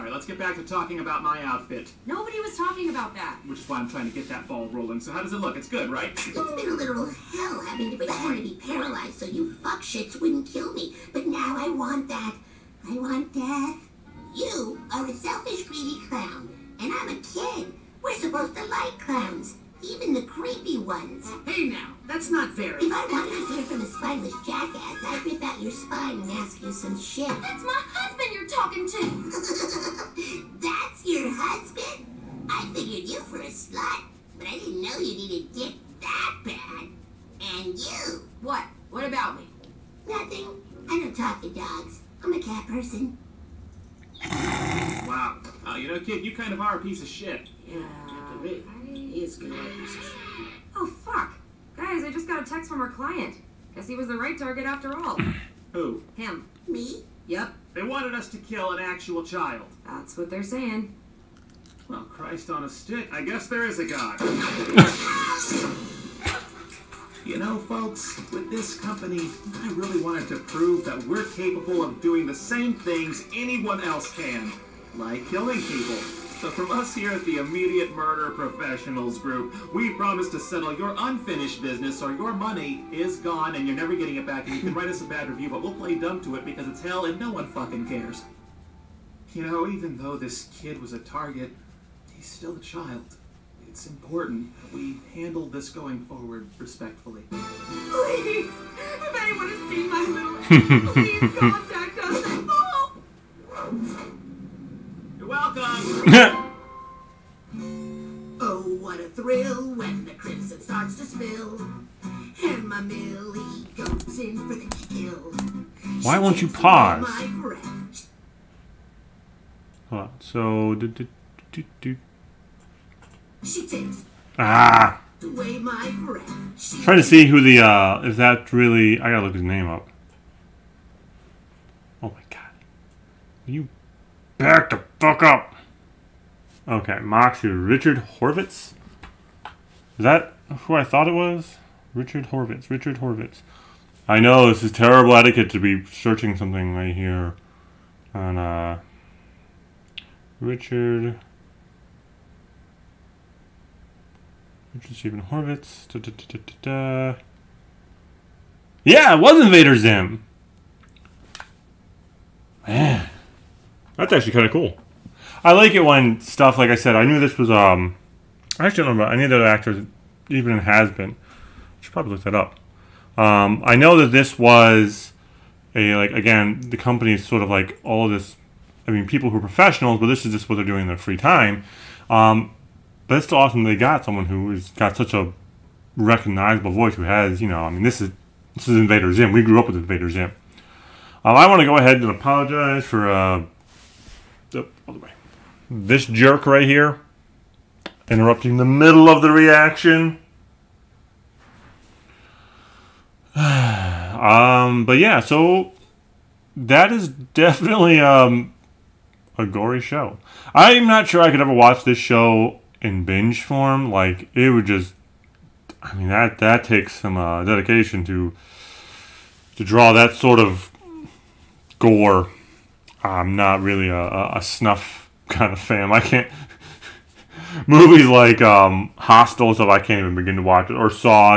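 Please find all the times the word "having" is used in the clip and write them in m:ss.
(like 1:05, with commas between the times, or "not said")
0:07.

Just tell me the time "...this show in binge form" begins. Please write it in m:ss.
3:31.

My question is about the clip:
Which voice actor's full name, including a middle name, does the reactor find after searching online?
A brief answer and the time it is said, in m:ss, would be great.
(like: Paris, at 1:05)
Richard Stephen Horvitz, at 2:34.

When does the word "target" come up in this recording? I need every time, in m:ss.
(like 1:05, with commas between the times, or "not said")
0:54, 1:30.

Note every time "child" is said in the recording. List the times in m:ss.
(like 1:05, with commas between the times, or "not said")
0:59, 1:32.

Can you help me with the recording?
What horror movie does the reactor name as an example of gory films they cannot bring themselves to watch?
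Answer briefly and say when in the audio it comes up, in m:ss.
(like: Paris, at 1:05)
Hostel, at 3:48.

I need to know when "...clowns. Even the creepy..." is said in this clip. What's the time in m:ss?
0:18.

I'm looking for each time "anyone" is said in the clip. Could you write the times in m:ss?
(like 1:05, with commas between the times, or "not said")
1:13, 1:39.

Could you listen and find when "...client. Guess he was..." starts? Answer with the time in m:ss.
0:52.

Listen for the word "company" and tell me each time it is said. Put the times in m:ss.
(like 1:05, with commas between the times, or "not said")
1:08, 2:56.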